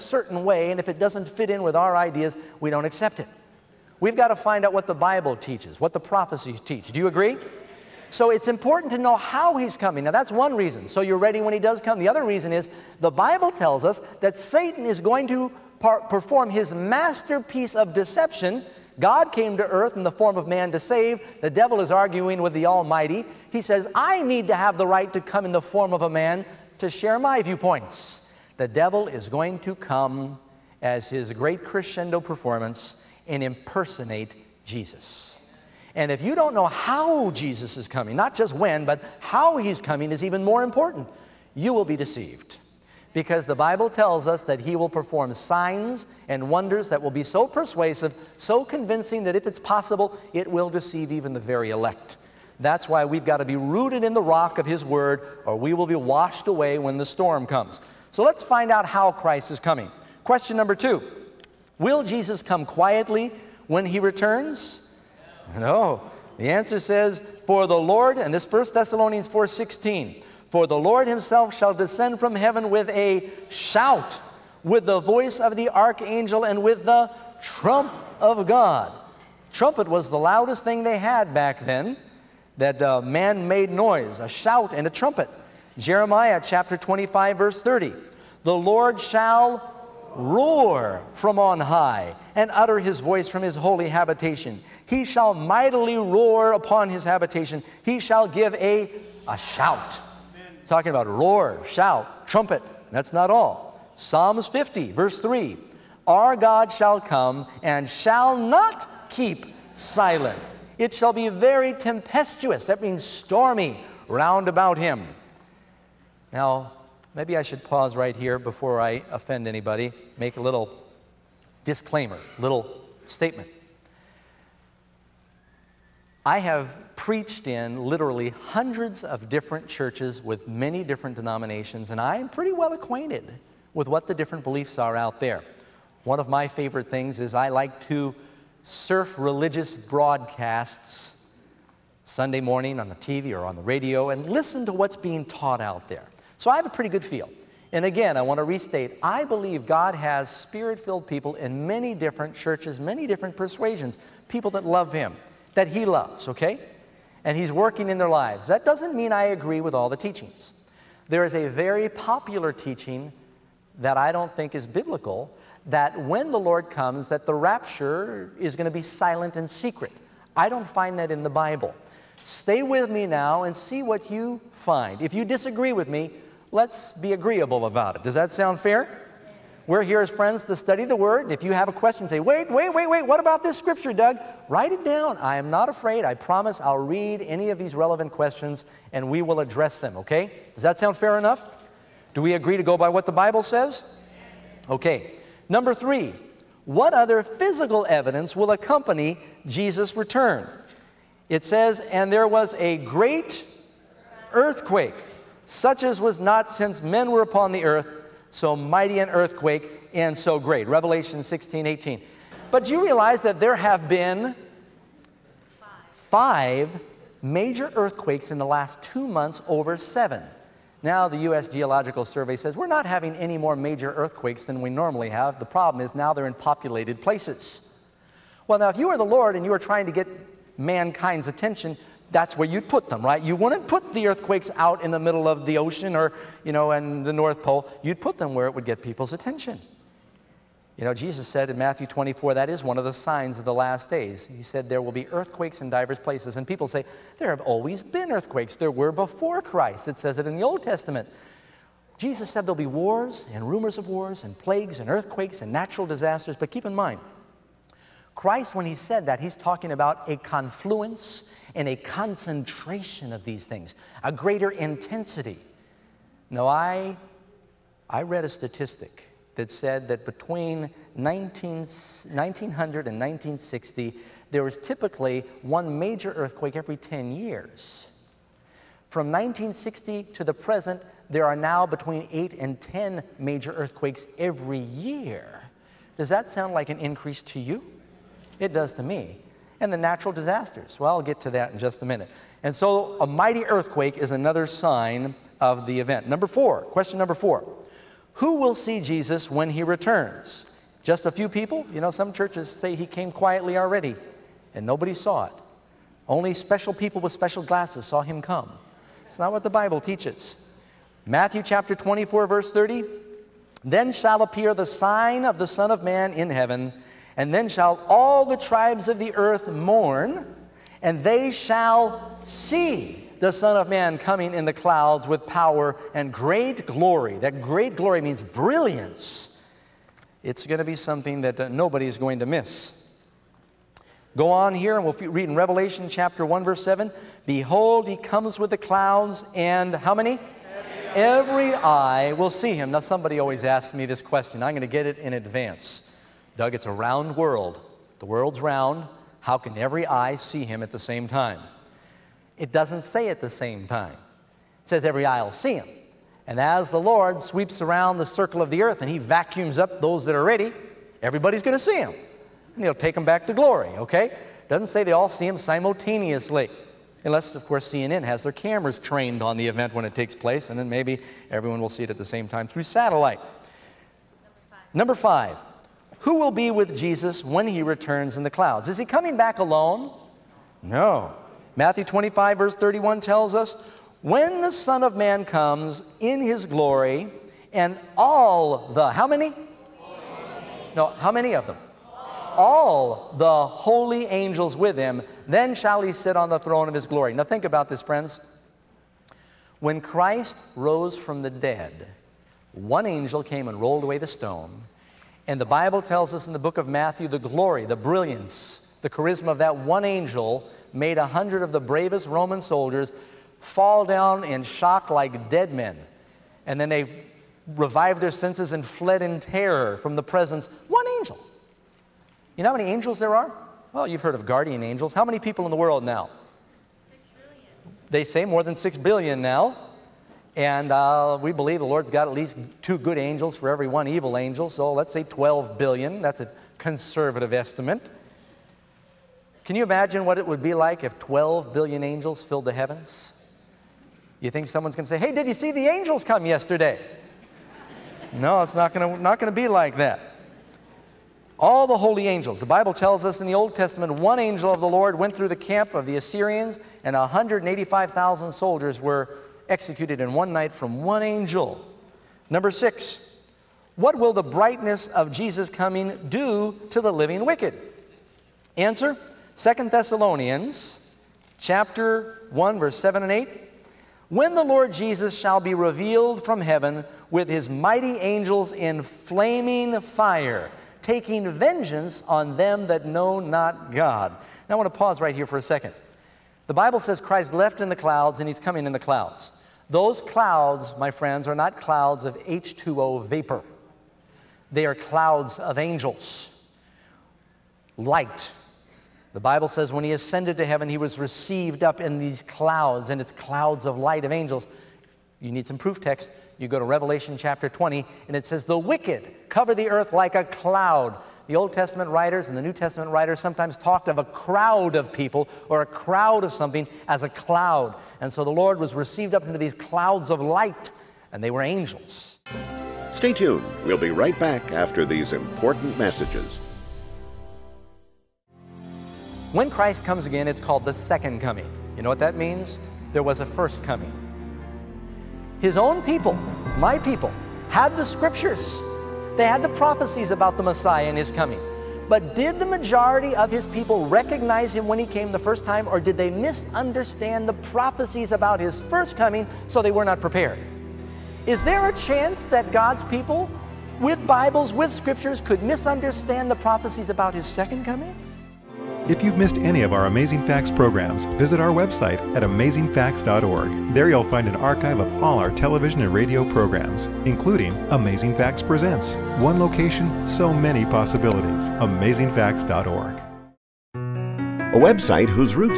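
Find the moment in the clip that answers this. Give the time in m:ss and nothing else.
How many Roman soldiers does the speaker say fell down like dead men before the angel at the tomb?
6:50.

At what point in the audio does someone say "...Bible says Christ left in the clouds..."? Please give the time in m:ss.
8:06.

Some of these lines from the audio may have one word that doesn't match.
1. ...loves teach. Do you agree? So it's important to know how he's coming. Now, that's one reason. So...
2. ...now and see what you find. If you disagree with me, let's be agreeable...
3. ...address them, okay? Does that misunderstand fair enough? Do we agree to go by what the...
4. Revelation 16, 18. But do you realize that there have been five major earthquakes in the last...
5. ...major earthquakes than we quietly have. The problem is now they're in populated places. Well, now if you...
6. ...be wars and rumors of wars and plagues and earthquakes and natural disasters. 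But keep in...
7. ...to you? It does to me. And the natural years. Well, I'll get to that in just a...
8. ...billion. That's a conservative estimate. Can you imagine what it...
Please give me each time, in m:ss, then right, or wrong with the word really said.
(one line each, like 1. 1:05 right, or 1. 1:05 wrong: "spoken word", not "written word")
1. 0:05 wrong: "prophecies", not "loves"
2. 2:53 right
3. 3:09 wrong: "sound", not "misunderstand"
4. 3:30 right
5. 3:43 wrong: "normally", not "quietly"
6. 4:12 right
7. 4:47 wrong: "disasters", not "years"
8. 7:15 right.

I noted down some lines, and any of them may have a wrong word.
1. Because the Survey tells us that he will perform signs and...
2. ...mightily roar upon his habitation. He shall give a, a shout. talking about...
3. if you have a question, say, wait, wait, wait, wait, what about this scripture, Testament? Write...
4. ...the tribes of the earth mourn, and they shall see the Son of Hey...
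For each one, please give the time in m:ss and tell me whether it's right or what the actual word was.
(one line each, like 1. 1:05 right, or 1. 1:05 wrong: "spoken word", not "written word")
1. 0:43 wrong: "Bible", not "Survey"
2. 1:35 right
3. 3:01 wrong: "Doug", not "Testament"
4. 5:18 wrong: "Man", not "Hey".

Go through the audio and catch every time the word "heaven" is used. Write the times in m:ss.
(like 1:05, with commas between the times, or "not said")
1:12, 5:16, 7:22, 7:56, 8:20.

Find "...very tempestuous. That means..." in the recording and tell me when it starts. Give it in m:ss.
1:51.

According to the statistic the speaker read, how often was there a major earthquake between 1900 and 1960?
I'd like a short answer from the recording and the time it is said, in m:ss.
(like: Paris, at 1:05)
one every 10 years, at 4:35.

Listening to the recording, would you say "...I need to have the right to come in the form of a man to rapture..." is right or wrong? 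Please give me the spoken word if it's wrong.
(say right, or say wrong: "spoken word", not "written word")
wrong: "share", not "rapture".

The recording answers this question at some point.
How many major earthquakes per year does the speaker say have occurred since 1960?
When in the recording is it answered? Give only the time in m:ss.
4:41.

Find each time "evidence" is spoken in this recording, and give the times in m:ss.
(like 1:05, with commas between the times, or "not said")
3:17.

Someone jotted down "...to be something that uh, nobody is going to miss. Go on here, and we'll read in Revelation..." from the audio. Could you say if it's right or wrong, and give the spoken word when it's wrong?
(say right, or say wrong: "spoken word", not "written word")
right.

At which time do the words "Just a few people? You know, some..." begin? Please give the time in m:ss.
5:00.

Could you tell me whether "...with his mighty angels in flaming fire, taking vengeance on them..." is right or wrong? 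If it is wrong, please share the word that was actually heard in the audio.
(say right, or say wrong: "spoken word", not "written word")
right.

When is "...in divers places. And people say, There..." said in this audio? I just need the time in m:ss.
4:05.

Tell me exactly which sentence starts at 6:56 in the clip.
And then they revived their senses and fled in terror from the presence one angel.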